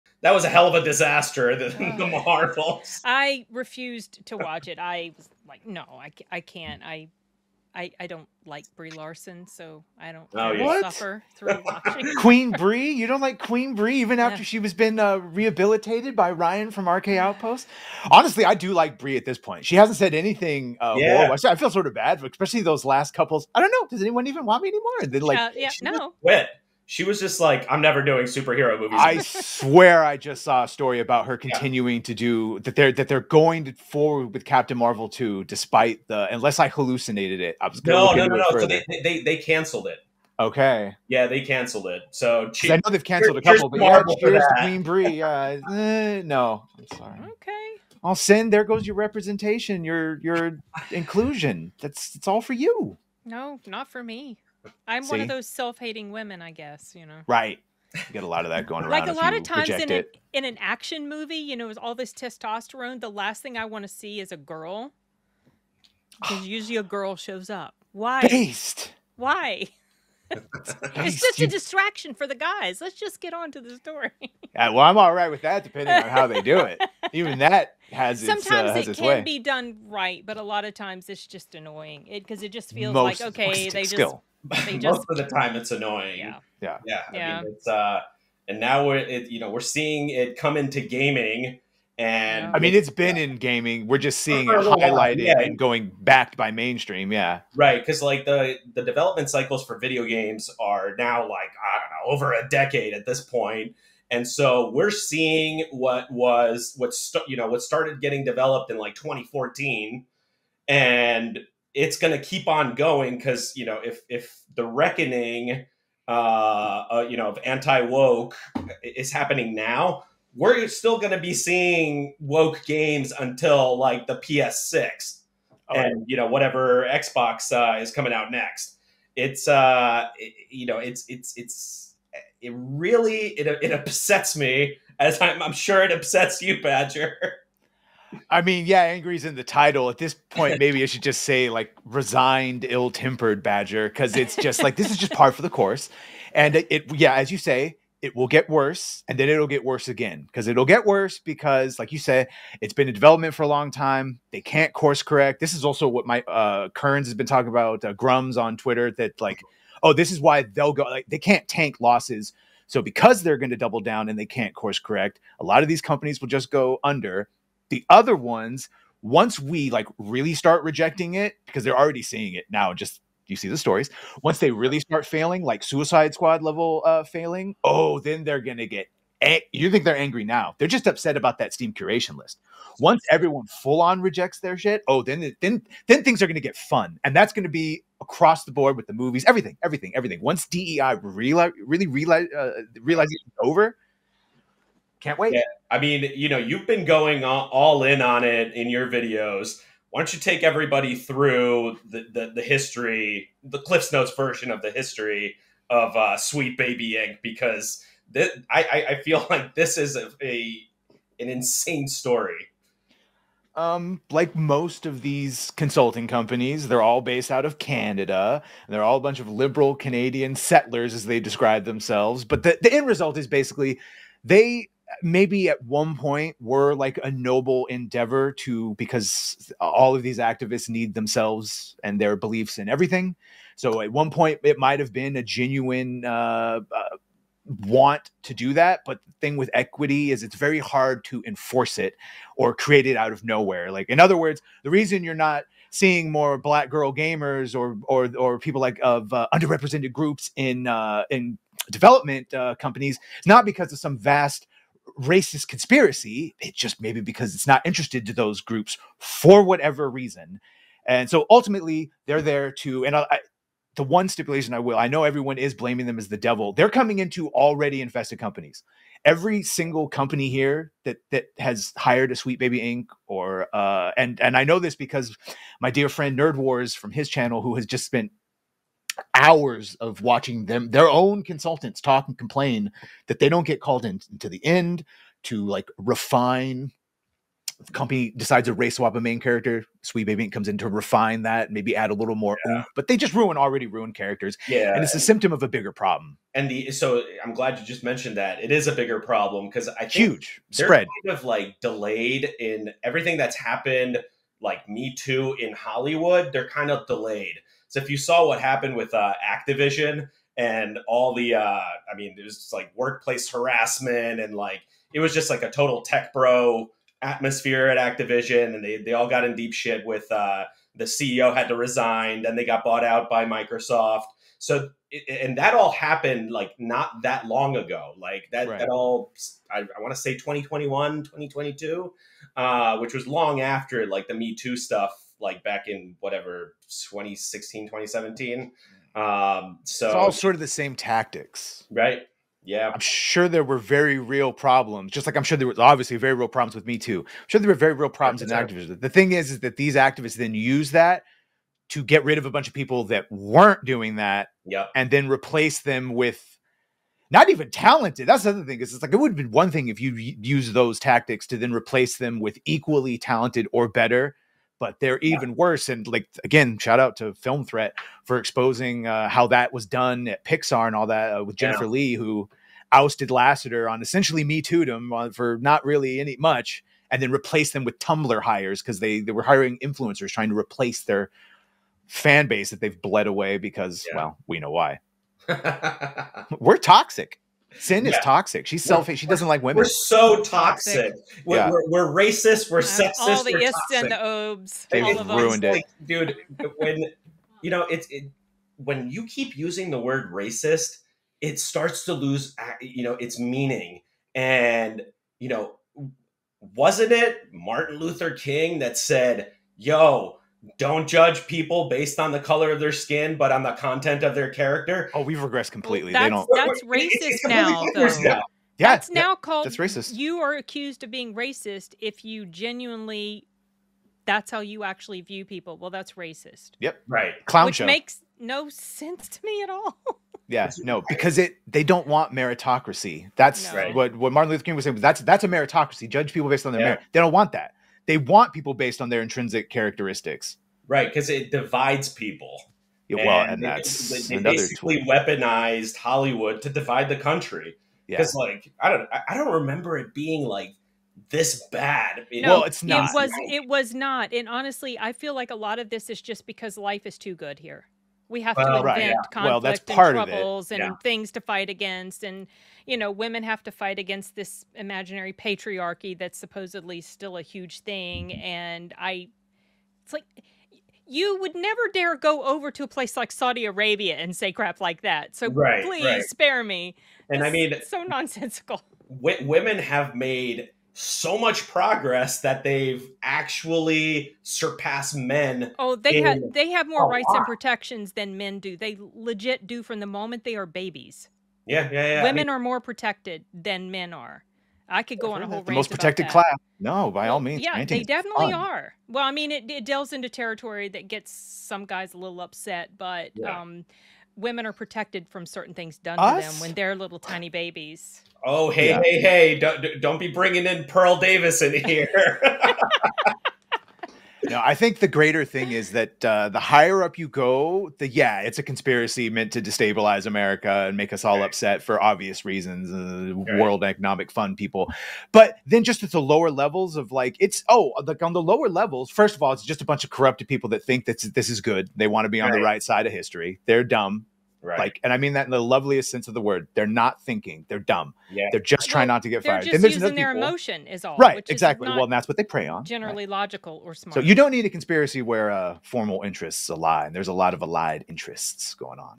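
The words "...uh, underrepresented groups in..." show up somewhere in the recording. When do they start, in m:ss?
4:09.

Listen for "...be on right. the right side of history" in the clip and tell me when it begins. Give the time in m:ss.
8:52.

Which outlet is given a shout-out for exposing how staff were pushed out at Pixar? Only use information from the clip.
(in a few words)
Film Threat.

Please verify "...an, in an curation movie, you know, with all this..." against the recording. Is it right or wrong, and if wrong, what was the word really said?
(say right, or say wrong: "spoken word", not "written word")
wrong: "action", not "curation".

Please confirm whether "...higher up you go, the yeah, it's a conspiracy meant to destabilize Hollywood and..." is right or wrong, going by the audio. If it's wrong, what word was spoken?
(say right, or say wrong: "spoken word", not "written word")
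wrong: "America", not "Hollywood".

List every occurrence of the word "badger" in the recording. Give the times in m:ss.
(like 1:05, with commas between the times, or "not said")
2:16, 2:23.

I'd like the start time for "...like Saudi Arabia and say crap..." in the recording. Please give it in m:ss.
7:52.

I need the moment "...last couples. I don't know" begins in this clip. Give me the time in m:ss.
0:22.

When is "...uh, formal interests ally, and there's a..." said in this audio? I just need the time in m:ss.
9:05.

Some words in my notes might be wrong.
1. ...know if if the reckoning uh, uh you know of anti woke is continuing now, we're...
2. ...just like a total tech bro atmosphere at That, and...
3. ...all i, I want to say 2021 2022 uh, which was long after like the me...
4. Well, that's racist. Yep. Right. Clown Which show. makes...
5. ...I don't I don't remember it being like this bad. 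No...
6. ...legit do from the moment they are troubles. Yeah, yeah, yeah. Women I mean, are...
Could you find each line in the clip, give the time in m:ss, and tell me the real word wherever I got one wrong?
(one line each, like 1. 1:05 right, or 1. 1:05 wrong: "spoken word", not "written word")
1. 1:53 wrong: "happening", not "continuing"
2. 5:15 wrong: "Activision", not "That"
3. 5:28 right
4. 7:05 right
5. 7:28 right
6. 8:08 wrong: "babies", not "troubles".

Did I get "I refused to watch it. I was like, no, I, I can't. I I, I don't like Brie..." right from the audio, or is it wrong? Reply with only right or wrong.
right.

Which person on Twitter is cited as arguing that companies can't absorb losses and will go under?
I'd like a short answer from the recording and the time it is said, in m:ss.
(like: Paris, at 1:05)
Grummz, at 2:37.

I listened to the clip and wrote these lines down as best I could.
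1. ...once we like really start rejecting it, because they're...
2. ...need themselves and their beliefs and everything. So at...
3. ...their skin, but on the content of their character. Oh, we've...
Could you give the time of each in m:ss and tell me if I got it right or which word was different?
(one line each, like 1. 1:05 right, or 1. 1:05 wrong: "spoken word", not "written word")
1. 2:49 right
2. 3:50 right
3. 6:52 right.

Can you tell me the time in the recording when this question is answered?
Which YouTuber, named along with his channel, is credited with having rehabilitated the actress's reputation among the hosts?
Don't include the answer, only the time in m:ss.
0:16.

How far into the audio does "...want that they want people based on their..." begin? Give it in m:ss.
7:17.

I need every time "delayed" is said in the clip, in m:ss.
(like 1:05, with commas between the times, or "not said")
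5:01, 5:06.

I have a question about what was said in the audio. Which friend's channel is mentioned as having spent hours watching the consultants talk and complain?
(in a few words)
Nerd Wars.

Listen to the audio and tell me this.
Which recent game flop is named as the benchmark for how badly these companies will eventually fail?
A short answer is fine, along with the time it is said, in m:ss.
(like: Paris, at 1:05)
Suicide Squad, at 2:55.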